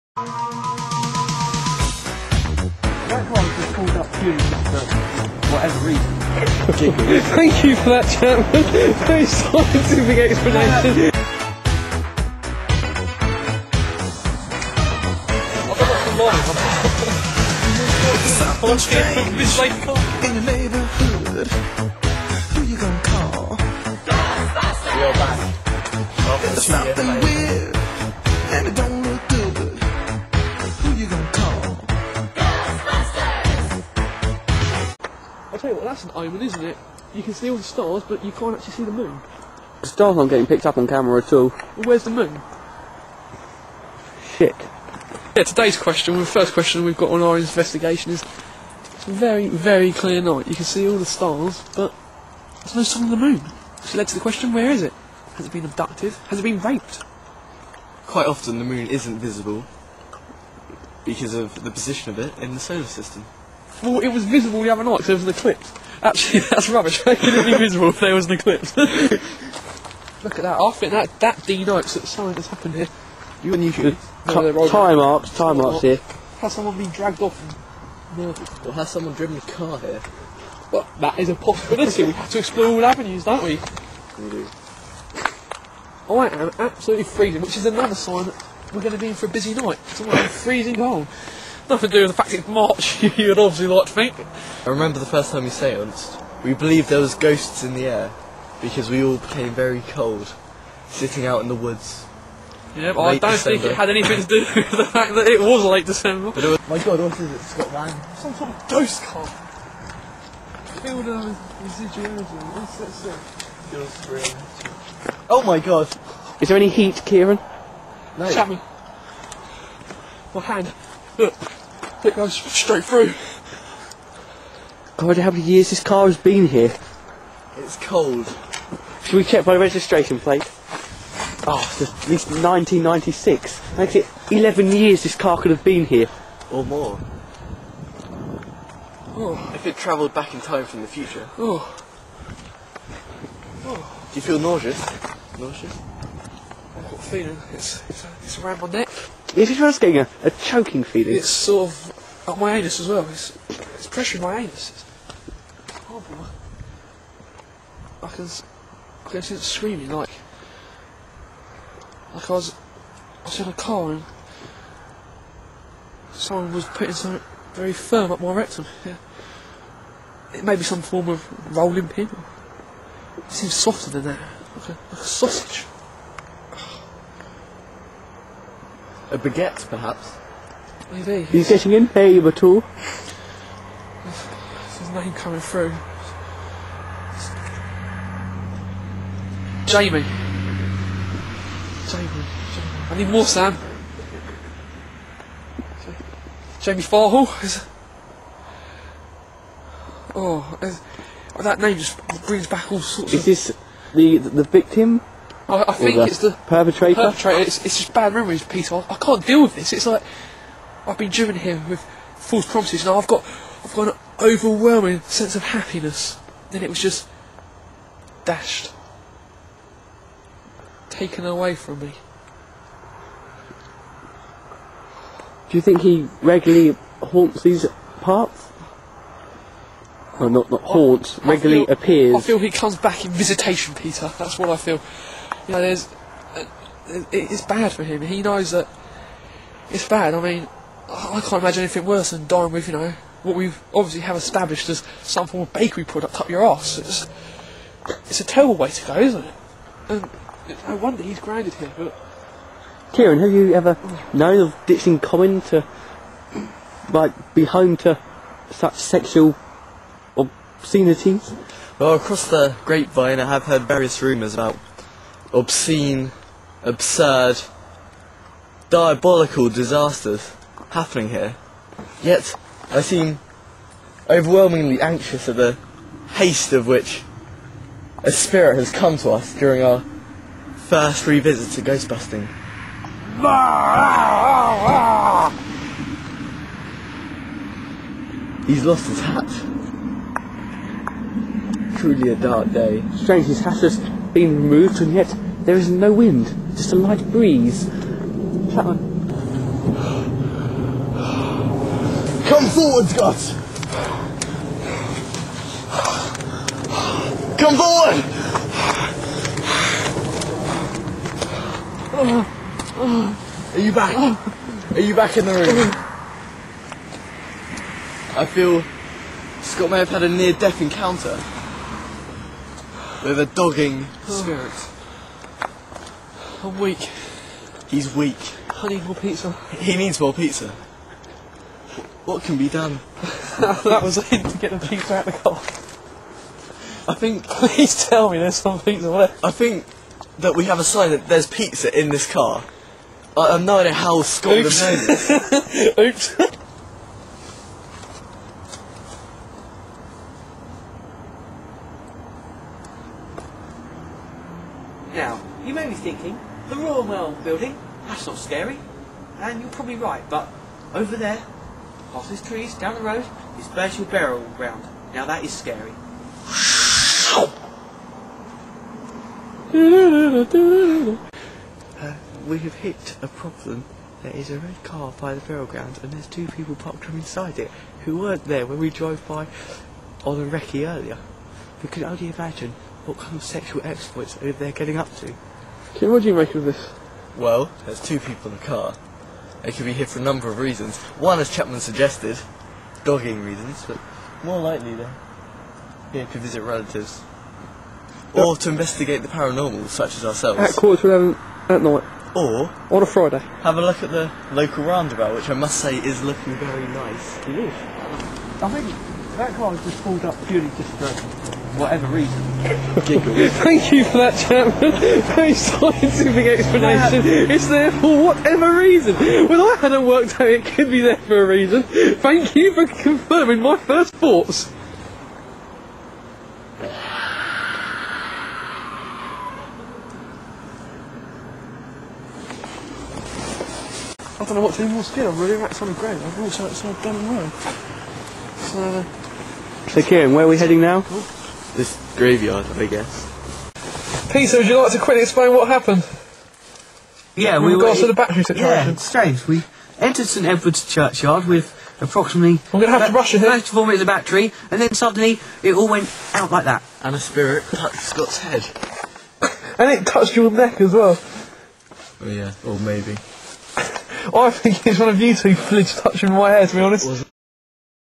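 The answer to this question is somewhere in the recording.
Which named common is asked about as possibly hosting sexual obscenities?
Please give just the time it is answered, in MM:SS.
04:14.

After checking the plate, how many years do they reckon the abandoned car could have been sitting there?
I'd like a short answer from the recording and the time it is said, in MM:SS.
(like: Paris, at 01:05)
11, at 02:14.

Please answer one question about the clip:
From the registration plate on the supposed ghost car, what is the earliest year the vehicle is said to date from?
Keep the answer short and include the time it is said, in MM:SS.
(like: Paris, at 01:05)
1996, at 02:12.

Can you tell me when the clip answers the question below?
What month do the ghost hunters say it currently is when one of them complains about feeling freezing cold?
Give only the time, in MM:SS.
01:32.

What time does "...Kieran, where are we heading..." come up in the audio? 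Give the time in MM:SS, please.
07:19.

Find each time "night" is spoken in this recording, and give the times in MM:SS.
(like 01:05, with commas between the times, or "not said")
00:50, 01:04, 01:29, 06:41.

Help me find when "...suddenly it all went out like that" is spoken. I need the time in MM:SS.
07:34.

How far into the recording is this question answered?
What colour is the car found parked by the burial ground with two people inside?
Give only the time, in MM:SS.
06:14.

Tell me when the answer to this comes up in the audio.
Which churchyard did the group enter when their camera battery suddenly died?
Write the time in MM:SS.
07:30.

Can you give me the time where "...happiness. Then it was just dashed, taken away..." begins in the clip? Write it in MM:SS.
03:35.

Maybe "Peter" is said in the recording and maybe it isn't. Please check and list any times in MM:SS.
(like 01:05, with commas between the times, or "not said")
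03:28, 03:53, 07:24.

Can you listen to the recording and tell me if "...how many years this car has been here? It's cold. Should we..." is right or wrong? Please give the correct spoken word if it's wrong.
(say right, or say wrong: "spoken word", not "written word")
right.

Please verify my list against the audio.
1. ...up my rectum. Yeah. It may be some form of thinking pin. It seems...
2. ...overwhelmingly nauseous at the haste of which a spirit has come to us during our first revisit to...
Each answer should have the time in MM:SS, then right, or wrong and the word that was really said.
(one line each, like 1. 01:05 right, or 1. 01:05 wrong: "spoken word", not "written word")
1. 02:48 wrong: "rolling", not "thinking"
2. 04:34 wrong: "anxious", not "nauseous".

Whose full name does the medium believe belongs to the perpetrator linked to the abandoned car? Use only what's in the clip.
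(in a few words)
Jamie Farhall.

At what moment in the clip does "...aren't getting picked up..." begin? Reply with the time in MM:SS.
00:40.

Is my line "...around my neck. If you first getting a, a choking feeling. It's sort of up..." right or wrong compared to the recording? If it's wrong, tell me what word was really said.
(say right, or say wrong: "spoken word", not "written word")
right.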